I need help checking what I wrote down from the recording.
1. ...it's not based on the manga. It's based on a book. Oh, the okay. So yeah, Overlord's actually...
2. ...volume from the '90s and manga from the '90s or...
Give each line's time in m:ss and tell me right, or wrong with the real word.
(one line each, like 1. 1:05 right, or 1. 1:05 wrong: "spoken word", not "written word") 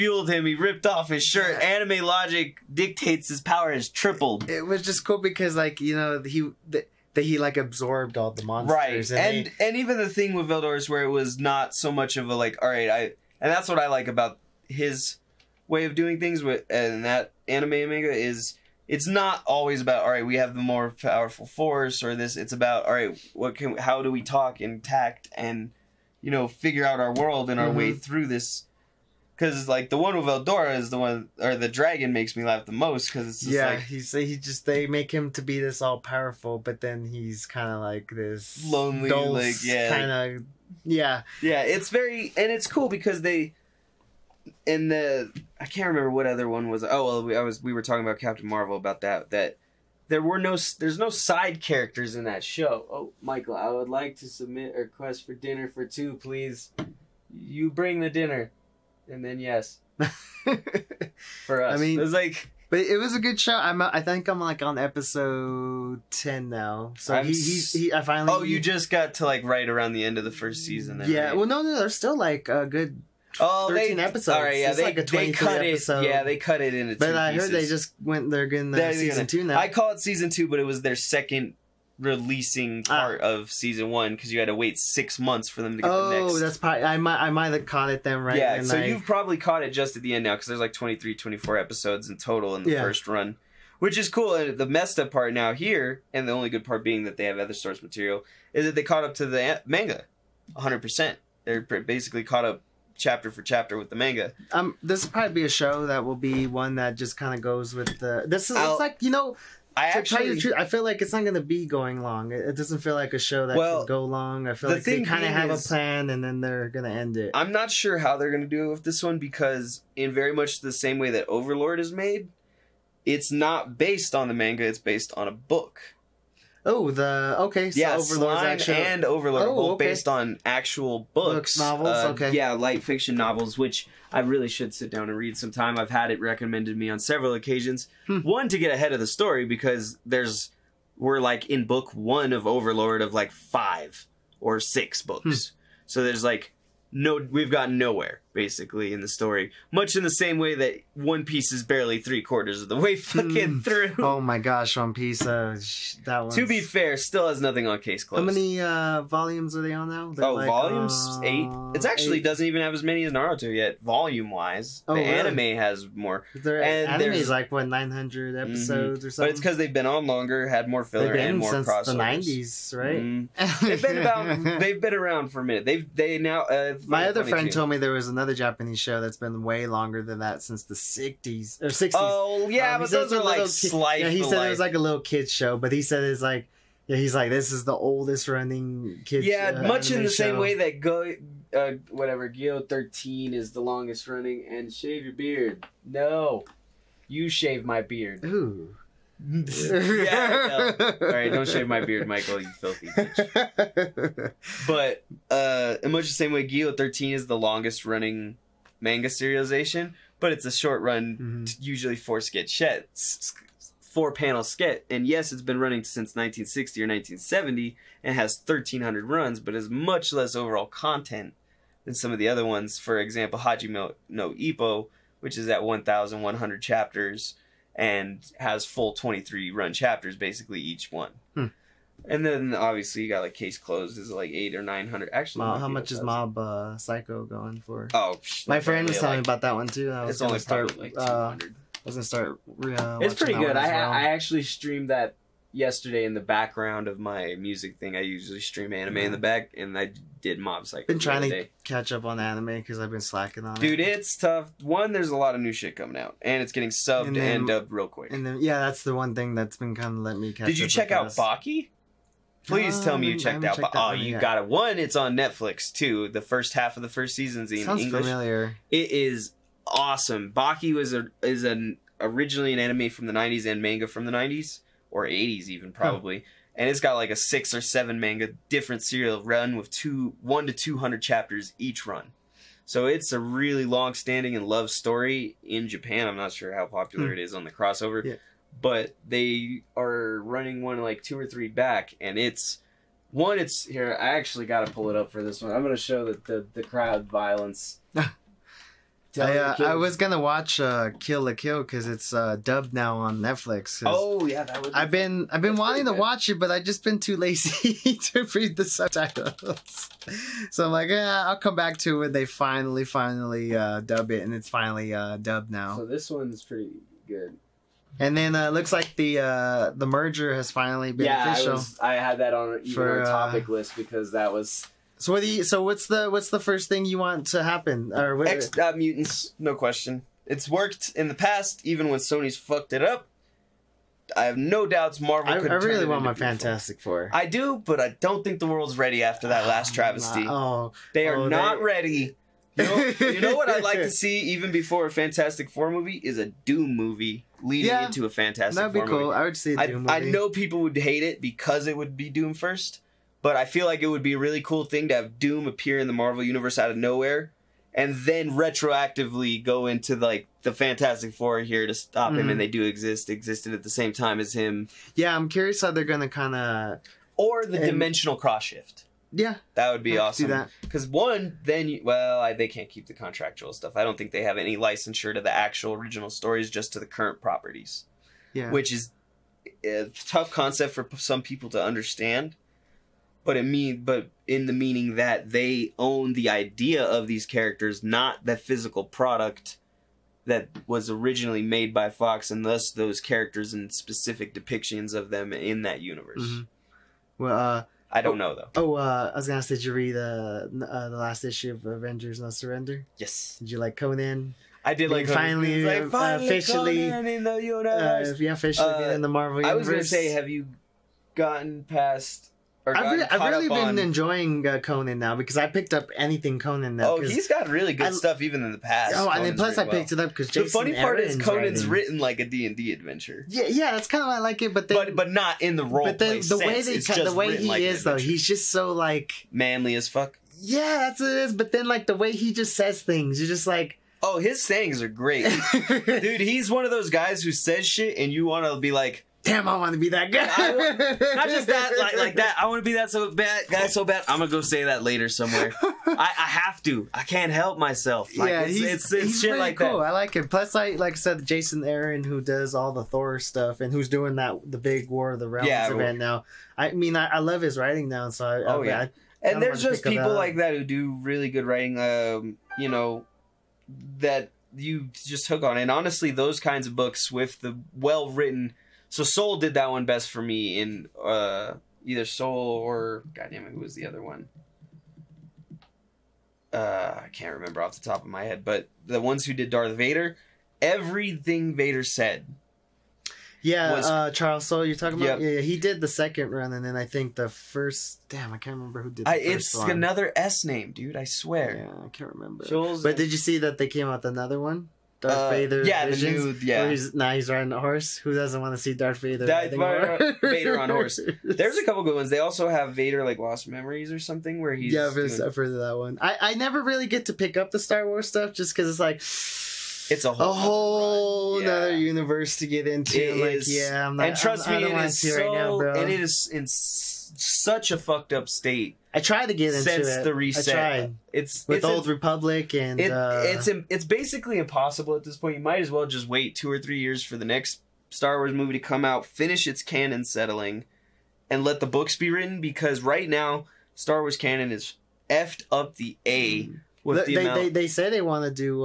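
1. 2:03 right
2. 4:32 wrong: "anime", not "volume".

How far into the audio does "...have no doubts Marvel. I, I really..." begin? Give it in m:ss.
5:34.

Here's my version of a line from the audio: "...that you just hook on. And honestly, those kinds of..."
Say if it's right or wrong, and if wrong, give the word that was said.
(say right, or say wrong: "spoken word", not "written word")
right.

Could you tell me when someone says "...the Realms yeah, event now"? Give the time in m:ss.
7:35.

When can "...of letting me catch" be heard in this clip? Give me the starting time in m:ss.
4:19.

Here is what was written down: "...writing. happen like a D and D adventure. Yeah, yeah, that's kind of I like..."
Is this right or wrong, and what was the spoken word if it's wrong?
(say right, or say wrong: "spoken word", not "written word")
wrong: "written", not "happen".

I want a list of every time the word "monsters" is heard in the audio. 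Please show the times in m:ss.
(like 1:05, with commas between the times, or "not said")
0:08.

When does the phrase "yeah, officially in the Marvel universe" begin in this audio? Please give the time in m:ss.
6:48.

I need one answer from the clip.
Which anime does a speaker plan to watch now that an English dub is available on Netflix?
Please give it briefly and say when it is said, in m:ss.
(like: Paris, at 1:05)
Kill la Kill, at 5:00.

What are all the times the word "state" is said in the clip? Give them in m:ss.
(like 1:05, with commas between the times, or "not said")
8:38.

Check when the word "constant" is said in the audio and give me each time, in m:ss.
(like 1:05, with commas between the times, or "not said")
not said.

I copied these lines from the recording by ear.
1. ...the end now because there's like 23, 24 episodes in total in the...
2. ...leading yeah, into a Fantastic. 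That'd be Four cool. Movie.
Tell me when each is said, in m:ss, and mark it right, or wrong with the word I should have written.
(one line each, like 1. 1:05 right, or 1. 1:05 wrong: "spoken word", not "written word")
1. 1:30 right
2. 5:47 right.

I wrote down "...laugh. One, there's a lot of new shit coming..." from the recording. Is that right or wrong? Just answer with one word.
wrong.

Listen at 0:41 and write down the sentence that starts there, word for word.
It's very and it's cool because they in the I can't remember what other one was.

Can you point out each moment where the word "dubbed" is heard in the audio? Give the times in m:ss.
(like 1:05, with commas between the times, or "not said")
4:17, 5:02, 5:15.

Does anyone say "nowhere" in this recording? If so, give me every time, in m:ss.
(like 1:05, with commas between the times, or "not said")
2:27, 5:56.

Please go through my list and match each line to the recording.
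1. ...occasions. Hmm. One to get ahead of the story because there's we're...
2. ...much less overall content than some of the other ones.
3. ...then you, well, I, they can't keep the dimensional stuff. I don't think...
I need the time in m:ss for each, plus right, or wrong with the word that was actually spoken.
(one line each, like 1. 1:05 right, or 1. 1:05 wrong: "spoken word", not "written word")
1. 2:17 right
2. 3:39 right
3. 6:11 wrong: "contractual", not "dimensional".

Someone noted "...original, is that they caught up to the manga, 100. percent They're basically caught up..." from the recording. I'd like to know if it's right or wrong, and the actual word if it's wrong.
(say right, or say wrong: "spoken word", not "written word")
wrong: "material", not "original".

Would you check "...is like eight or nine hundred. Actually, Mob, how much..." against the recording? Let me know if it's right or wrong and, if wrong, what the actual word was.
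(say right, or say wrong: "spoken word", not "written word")
right.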